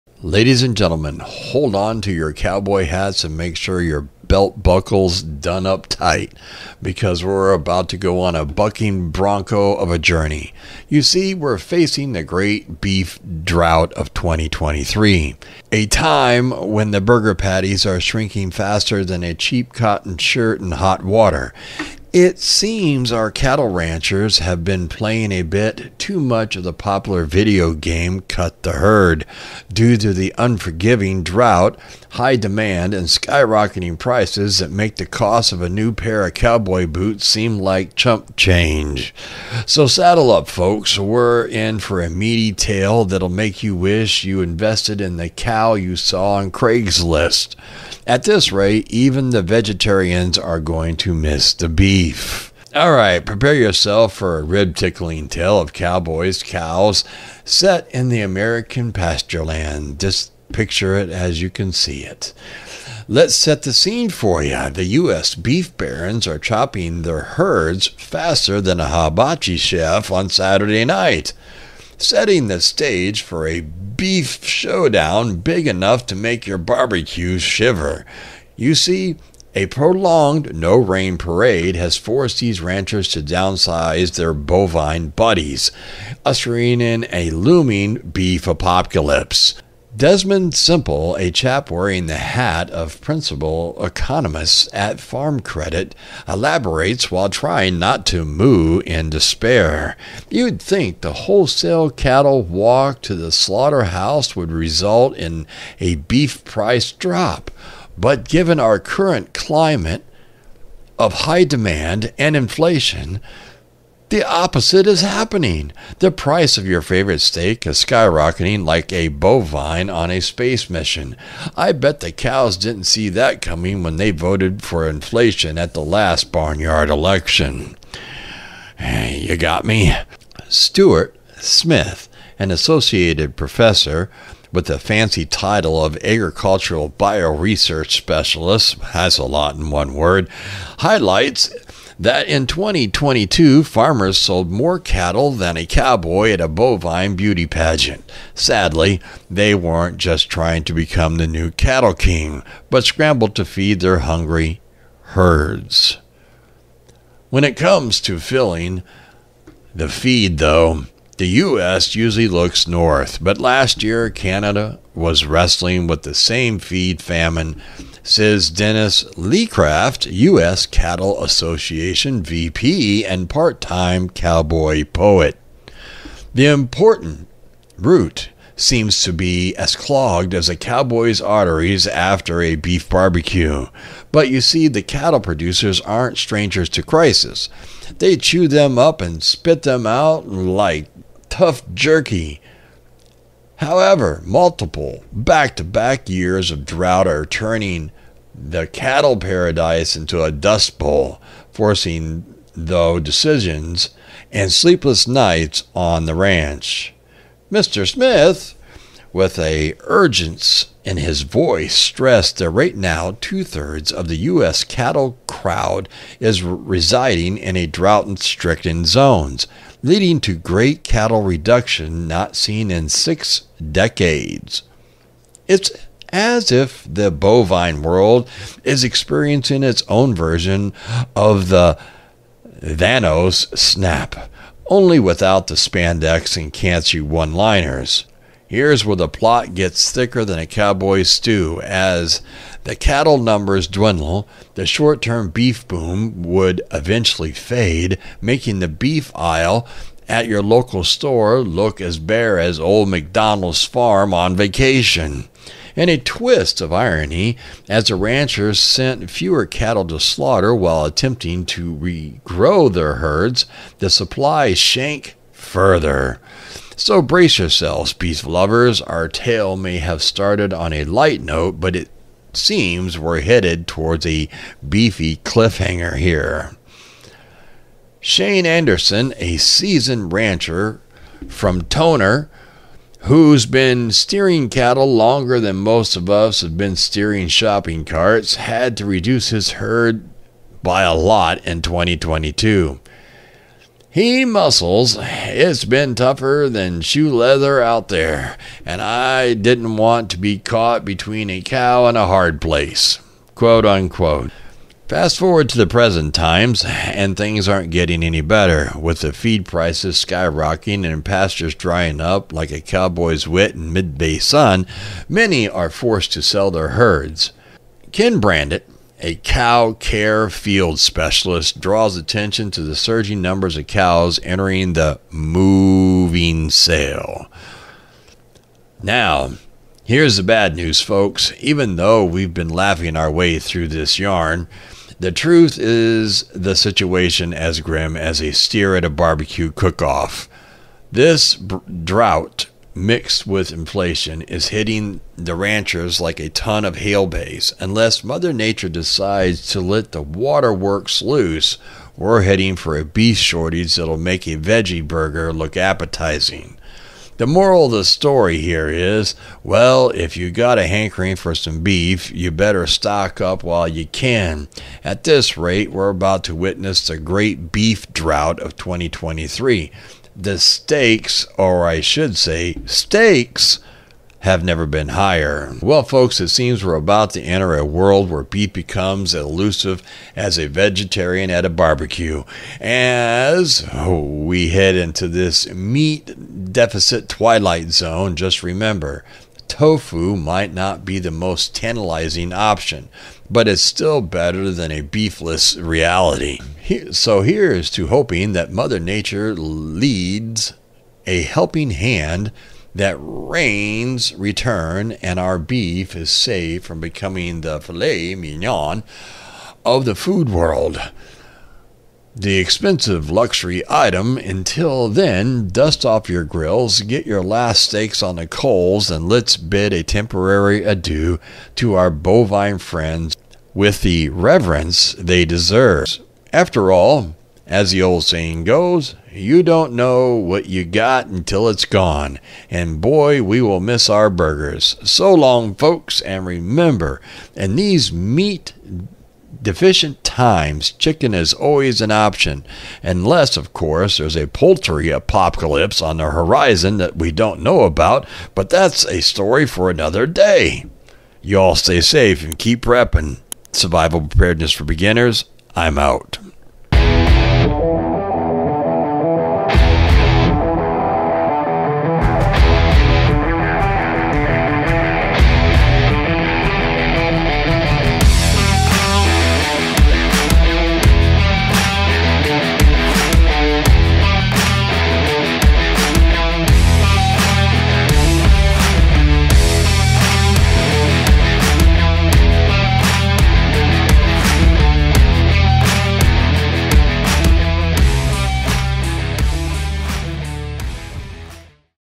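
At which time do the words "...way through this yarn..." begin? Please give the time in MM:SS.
05:33.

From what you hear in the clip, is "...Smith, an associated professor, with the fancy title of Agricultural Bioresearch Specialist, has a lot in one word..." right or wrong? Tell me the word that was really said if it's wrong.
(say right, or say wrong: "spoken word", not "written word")
right.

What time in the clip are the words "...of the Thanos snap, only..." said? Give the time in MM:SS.
03:51.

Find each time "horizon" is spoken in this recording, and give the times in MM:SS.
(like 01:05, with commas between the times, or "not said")
07:26.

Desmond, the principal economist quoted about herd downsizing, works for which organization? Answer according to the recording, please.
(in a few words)
Farm Credit.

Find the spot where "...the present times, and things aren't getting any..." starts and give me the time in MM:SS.
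05:05.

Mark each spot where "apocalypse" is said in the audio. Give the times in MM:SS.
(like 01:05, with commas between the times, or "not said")
01:28, 07:24.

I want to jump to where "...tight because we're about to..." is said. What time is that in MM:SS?
00:05.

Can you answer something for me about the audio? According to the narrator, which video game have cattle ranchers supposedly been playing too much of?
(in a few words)
Cut the Herd.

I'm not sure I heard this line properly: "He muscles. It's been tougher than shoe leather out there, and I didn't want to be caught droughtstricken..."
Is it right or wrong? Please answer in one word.
wrong.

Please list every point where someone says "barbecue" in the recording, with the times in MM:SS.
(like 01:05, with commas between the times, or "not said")
01:16, 03:02, 05:38, 06:21.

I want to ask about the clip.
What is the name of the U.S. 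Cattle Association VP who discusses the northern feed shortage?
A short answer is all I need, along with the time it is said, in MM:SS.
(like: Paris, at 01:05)
Dennis Laycraft, at 02:48.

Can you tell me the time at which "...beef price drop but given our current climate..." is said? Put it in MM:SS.
01:45.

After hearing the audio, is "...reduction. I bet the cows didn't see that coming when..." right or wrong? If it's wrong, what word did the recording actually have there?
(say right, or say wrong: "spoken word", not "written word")
wrong: "mission", not "reduction".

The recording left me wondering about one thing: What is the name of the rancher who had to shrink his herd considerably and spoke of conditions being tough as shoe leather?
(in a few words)
Shane Anderson.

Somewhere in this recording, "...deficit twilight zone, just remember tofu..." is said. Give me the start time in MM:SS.
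06:26.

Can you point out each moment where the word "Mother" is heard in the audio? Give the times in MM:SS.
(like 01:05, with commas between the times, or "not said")
05:48, 06:38.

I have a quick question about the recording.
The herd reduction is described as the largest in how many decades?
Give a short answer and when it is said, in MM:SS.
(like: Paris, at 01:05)
6, at 03:42.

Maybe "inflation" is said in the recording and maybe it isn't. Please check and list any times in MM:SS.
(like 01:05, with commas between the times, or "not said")
01:52, 02:04, 05:43.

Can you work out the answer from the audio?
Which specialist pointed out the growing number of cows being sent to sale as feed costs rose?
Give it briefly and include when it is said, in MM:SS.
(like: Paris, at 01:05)
Ken Brandit, at 05:17.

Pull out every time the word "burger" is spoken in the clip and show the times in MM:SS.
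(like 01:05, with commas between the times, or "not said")
00:17, 05:54, 07:14.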